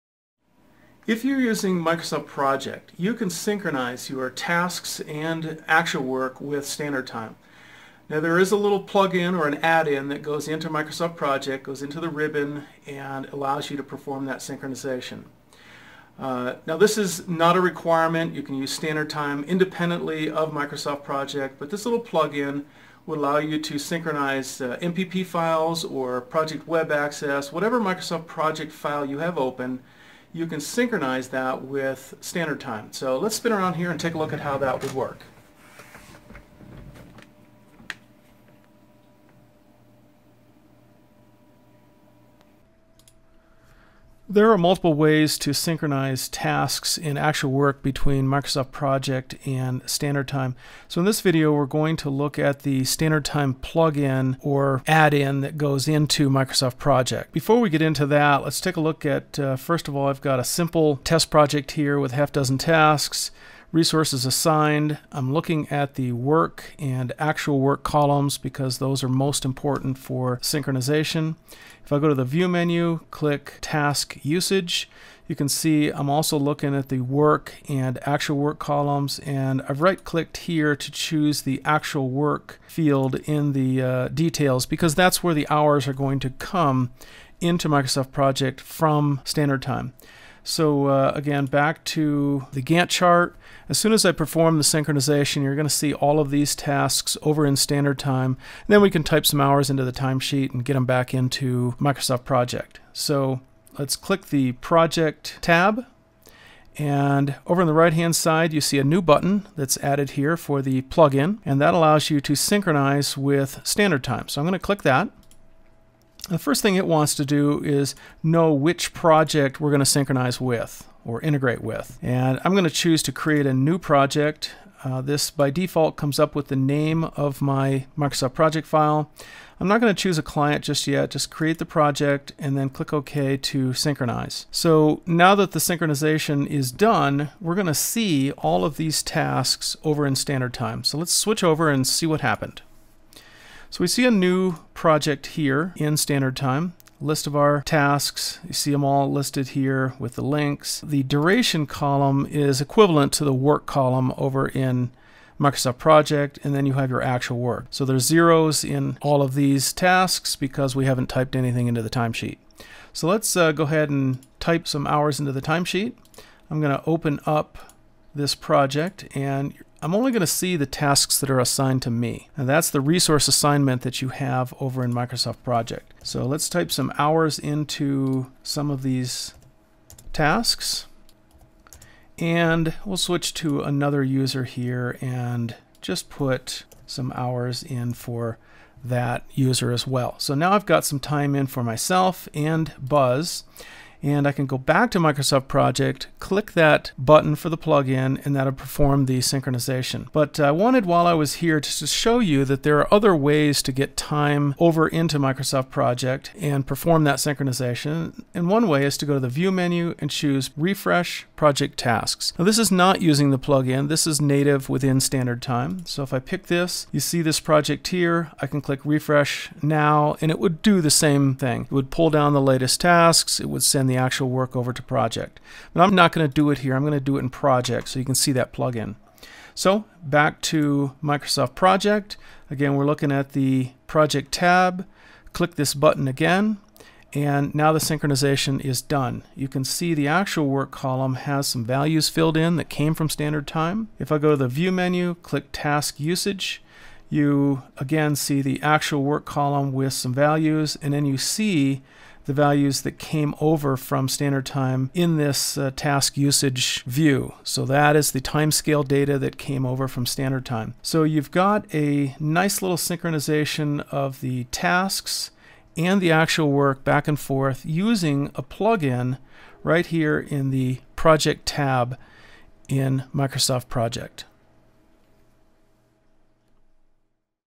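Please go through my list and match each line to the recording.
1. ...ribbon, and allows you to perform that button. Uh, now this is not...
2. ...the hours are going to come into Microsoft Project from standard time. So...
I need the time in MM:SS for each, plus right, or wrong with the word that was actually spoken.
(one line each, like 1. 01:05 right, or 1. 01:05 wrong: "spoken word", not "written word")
1. 00:12 wrong: "synchronization", not "button"
2. 01:25 right.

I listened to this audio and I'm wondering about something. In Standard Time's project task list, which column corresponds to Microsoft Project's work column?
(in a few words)
Duration.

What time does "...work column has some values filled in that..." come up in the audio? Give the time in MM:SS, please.
04:00.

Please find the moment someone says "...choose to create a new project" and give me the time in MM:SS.
02:02.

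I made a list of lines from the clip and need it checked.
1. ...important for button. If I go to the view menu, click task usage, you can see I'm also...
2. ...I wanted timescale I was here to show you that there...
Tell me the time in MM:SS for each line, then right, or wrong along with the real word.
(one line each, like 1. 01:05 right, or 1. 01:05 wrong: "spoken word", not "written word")
1. 01:09 wrong: "synchronization", not "button"
2. 03:20 wrong: "while", not "timescale".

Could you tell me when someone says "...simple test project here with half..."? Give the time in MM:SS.
01:00.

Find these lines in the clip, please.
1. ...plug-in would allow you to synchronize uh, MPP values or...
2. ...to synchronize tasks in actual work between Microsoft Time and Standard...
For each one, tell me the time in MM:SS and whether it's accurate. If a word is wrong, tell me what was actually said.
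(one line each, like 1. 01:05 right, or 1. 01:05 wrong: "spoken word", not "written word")
1. 00:21 wrong: "files", not "values"
2. 00:45 wrong: "Project", not "Time".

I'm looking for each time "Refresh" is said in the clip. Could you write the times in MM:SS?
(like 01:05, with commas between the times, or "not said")
03:30, 03:38.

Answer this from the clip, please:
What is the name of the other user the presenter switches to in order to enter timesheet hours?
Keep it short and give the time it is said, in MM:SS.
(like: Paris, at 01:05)
Buzz, at 03:12.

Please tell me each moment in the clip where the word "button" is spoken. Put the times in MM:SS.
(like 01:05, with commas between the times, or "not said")
01:49, 03:16, 03:55.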